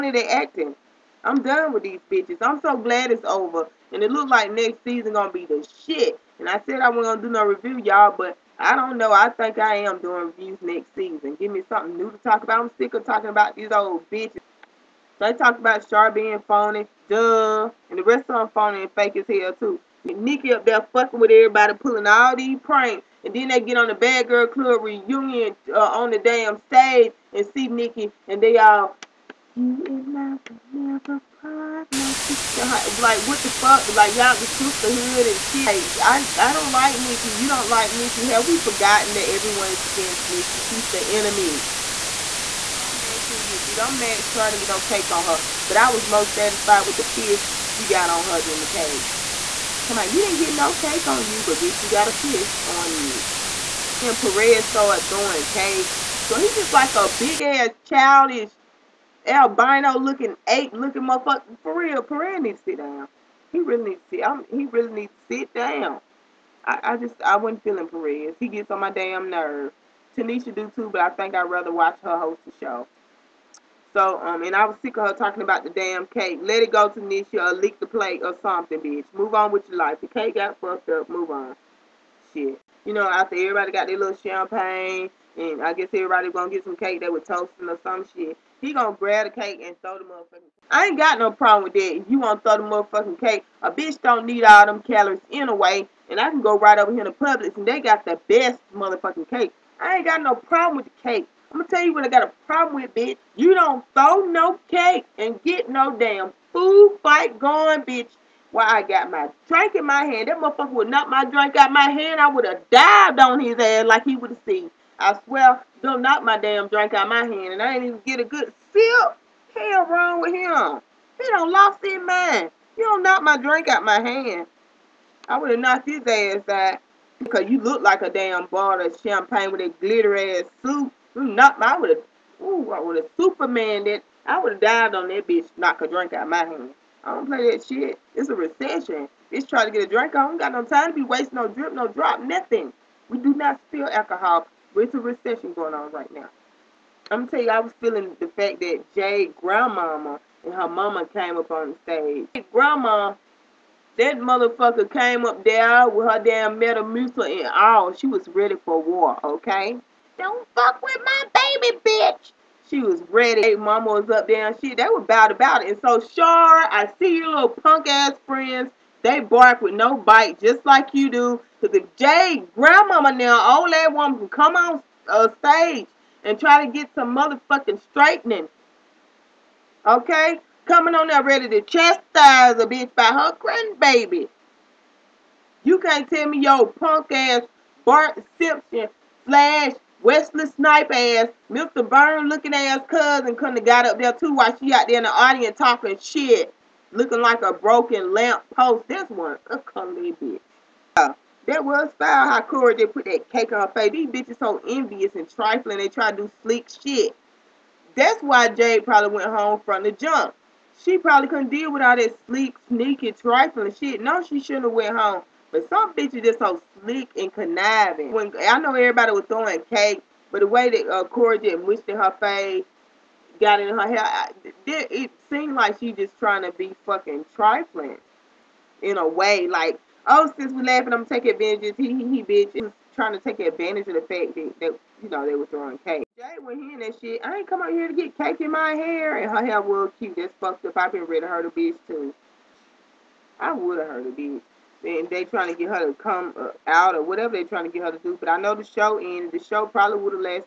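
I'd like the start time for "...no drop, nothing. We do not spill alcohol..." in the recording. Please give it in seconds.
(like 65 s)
141 s.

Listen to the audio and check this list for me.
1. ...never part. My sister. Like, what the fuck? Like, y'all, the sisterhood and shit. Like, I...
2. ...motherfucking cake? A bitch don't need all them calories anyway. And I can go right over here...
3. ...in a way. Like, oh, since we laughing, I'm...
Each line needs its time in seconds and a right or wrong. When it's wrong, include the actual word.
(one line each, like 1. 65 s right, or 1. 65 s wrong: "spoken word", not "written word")
1. 30 s right
2. 92 s right
3. 228 s right.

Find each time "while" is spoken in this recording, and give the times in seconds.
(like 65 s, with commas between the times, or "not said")
108 s, 194 s.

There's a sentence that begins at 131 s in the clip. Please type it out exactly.
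Knock, my, I would have, ooh, I would have Supermaned it.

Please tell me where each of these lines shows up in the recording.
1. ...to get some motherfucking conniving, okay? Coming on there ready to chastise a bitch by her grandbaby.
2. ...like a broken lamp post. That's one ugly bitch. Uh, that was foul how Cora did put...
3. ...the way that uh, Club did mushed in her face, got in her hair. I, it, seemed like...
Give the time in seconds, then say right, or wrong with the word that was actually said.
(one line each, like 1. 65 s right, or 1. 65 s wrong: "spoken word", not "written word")
1. 176 s wrong: "straightening", not "conniving"
2. 197 s right
3. 220 s wrong: "Cora", not "Club".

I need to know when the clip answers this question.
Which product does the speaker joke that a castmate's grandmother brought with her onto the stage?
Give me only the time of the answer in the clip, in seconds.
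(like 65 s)
156 s.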